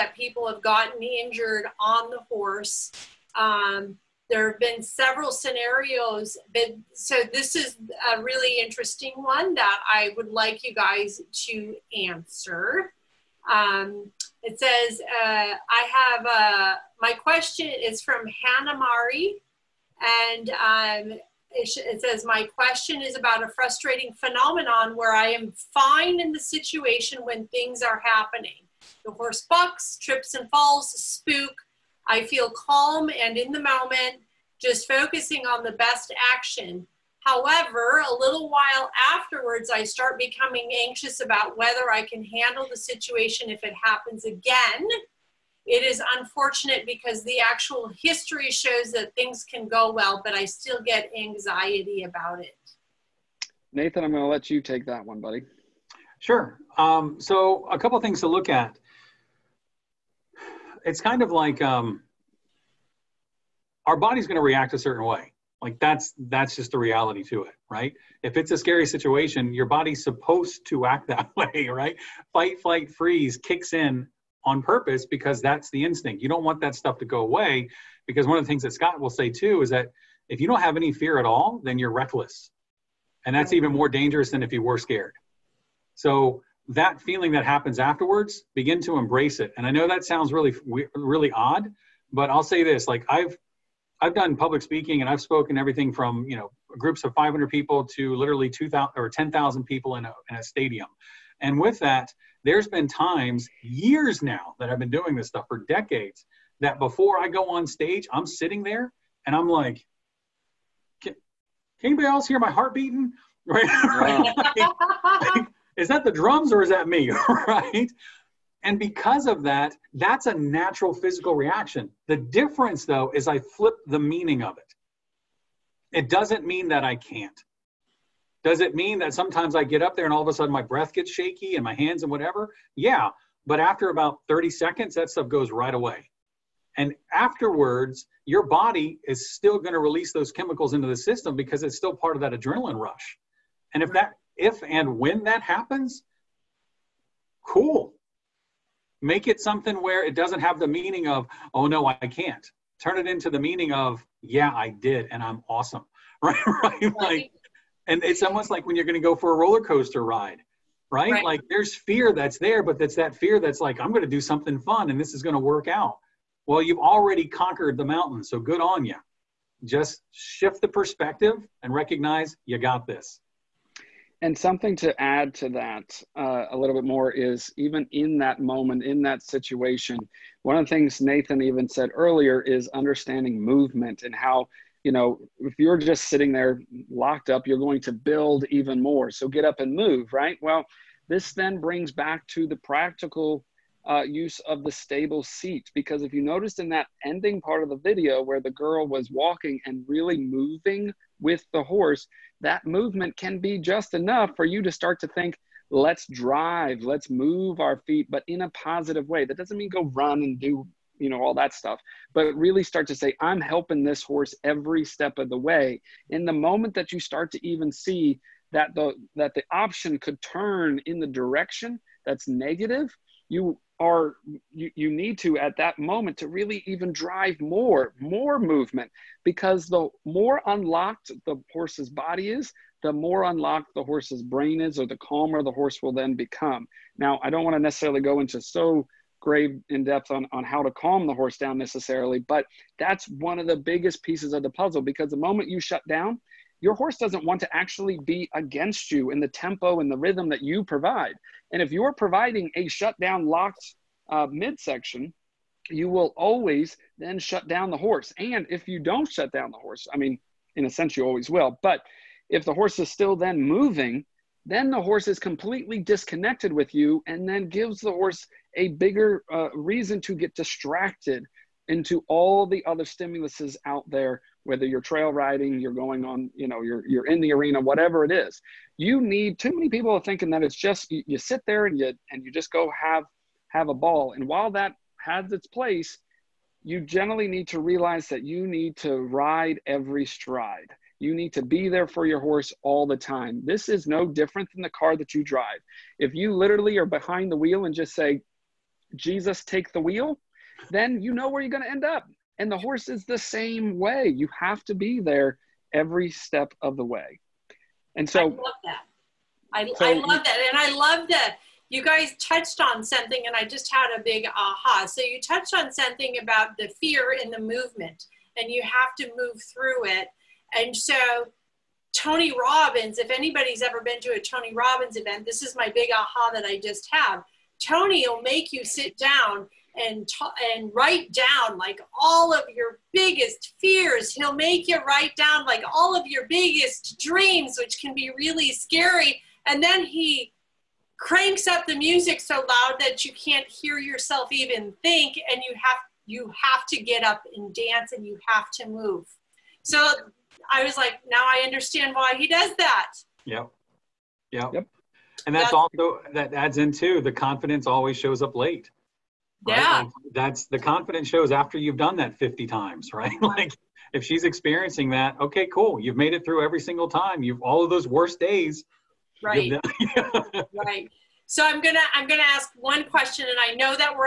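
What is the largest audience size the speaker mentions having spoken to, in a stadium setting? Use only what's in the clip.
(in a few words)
10,000.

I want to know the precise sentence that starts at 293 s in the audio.
This is no different than the car that you drive.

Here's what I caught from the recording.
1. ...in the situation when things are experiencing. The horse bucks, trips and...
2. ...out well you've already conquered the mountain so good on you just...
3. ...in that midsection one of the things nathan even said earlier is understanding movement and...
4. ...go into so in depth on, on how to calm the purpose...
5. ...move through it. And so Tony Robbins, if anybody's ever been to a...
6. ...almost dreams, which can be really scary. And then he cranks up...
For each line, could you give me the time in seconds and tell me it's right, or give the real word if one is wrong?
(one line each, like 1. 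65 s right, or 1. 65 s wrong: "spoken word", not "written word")
1. 26 s wrong: "happening", not "experiencing"
2. 165 s right
3. 178 s wrong: "situation", not "midsection"
4. 238 s wrong: "horse", not "purpose"
5. 319 s right
6. 336 s wrong: "biggest", not "almost".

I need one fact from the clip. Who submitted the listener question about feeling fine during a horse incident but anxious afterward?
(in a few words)
Hannah Marie.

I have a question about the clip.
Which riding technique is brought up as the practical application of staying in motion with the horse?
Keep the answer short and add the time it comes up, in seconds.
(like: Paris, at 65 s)
stable seat, at 194 s.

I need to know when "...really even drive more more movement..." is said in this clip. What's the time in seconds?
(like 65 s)
226 s.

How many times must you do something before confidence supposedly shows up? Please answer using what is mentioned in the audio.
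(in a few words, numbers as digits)
50.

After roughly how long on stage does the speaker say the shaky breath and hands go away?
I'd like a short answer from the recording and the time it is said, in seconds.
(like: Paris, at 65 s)
30 seconds, at 134 s.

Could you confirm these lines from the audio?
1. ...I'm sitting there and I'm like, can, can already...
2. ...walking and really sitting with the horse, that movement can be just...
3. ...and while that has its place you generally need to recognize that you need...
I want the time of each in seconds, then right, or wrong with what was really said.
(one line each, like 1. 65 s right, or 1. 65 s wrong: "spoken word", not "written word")
1. 108 s wrong: "anybody", not "already"
2. 199 s wrong: "moving", not "sitting"
3. 284 s wrong: "realize", not "recognize".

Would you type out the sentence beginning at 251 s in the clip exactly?
And if you're providing a shutdown locked uh, midsection, you will always then shut down the horse.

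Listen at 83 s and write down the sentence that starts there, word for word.
And that's even more dangerous than if you were scared.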